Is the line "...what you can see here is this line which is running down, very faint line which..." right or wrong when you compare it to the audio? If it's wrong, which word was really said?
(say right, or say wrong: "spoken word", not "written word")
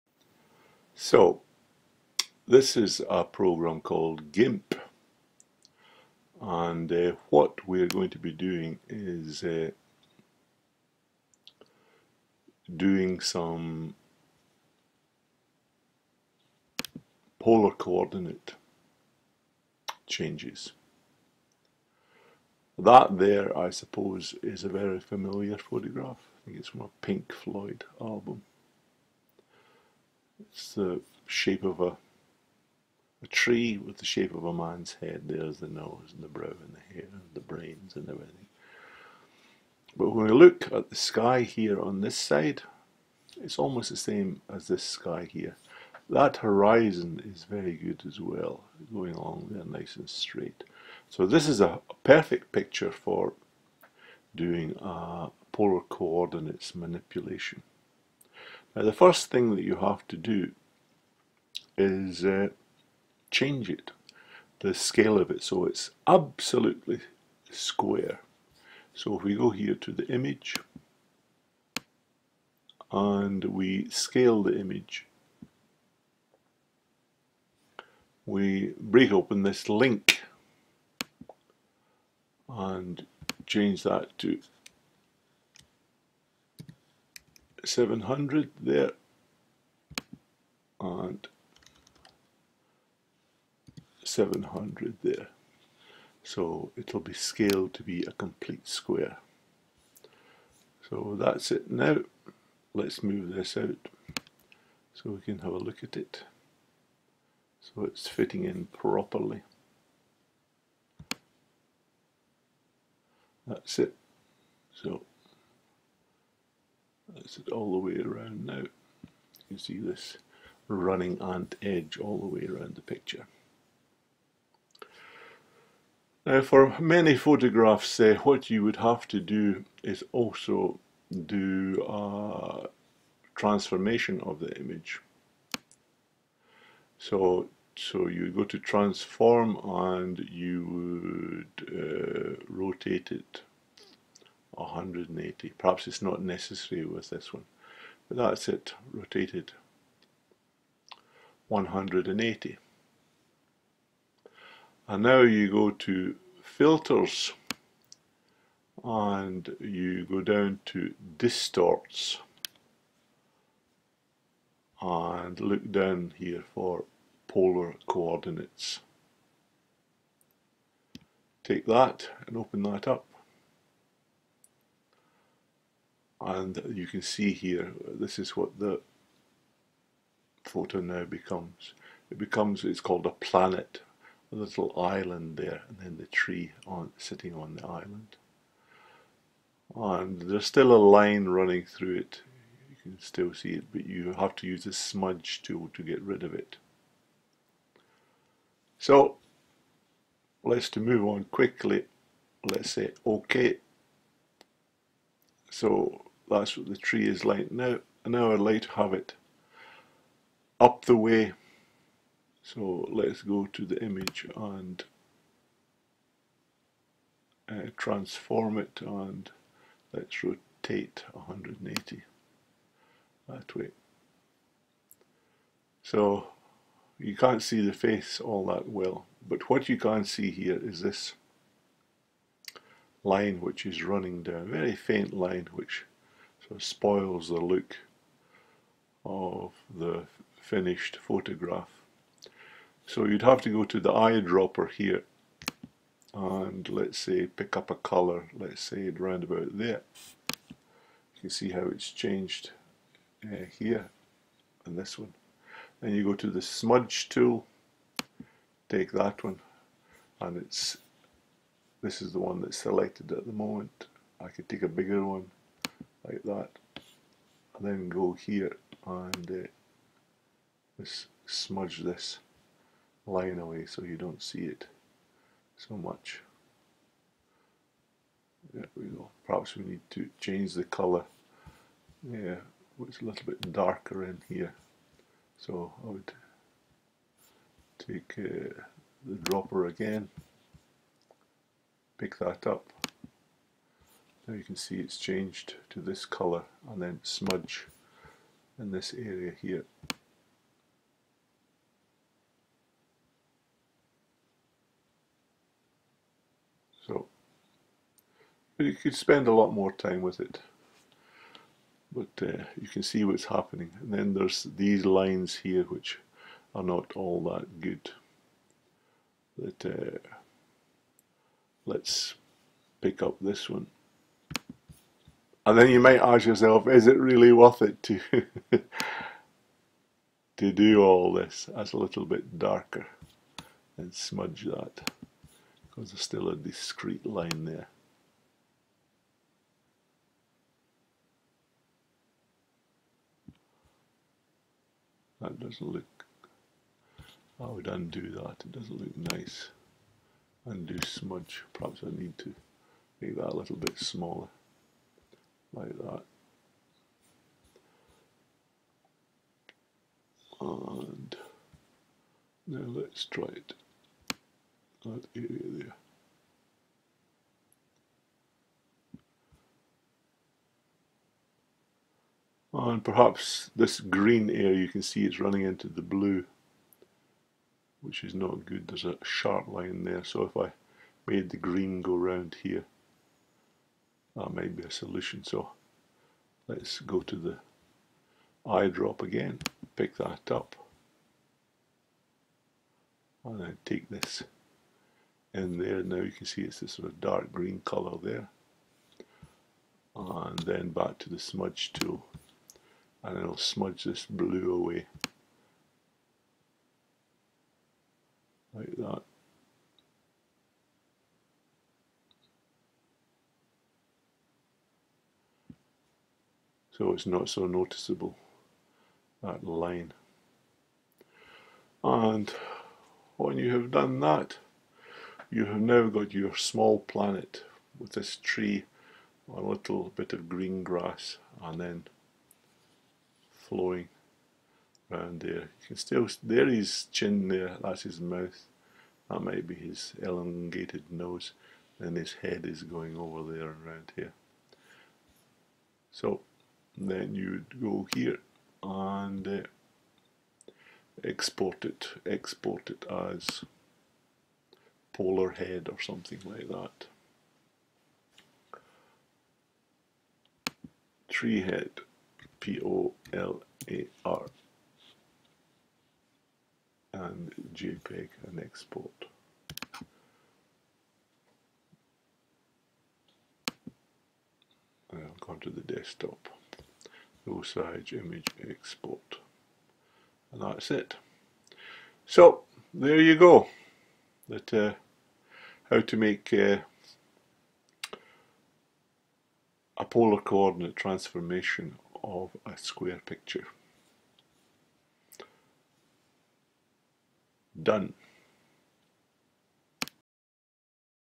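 right.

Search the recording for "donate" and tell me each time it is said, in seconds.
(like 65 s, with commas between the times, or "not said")
not said.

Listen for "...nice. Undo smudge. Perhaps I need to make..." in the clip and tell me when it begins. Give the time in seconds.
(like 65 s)
349 s.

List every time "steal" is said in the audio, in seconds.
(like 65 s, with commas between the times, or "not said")
not said.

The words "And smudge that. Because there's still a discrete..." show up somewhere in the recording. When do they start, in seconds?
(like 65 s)
333 s.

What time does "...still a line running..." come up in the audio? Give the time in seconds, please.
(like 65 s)
190 s.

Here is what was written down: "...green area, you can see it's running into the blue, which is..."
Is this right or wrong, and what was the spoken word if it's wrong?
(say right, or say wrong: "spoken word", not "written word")
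right.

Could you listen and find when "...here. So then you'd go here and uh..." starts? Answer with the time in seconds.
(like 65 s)
443 s.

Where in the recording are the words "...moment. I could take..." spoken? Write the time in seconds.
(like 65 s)
263 s.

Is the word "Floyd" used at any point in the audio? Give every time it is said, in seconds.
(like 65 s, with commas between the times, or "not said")
27 s.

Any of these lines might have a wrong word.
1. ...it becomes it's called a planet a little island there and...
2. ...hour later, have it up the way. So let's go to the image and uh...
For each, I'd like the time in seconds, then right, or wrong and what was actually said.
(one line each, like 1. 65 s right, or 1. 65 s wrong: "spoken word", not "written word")
1. 182 s right
2. 208 s right.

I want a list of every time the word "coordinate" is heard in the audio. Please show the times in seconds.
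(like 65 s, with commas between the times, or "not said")
17 s, 55 s, 167 s, 490 s.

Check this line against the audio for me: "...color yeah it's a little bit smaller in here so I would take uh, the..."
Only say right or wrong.
wrong.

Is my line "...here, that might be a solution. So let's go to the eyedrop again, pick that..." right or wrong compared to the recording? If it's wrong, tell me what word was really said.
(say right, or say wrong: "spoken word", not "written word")
right.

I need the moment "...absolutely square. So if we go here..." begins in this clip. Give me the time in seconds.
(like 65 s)
66 s.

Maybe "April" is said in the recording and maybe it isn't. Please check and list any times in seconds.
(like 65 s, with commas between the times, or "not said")
not said.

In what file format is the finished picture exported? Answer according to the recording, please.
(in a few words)
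JPEG.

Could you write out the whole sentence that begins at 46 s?
That horizon is very good as well, going along there nice and straight.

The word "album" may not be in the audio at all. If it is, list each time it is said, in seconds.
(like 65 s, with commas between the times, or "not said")
27 s.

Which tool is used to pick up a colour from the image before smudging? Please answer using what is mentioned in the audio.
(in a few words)
eyedropper.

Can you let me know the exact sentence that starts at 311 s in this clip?
But uh, you can see what's happening.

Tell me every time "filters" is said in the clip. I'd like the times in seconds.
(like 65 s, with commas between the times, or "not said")
156 s.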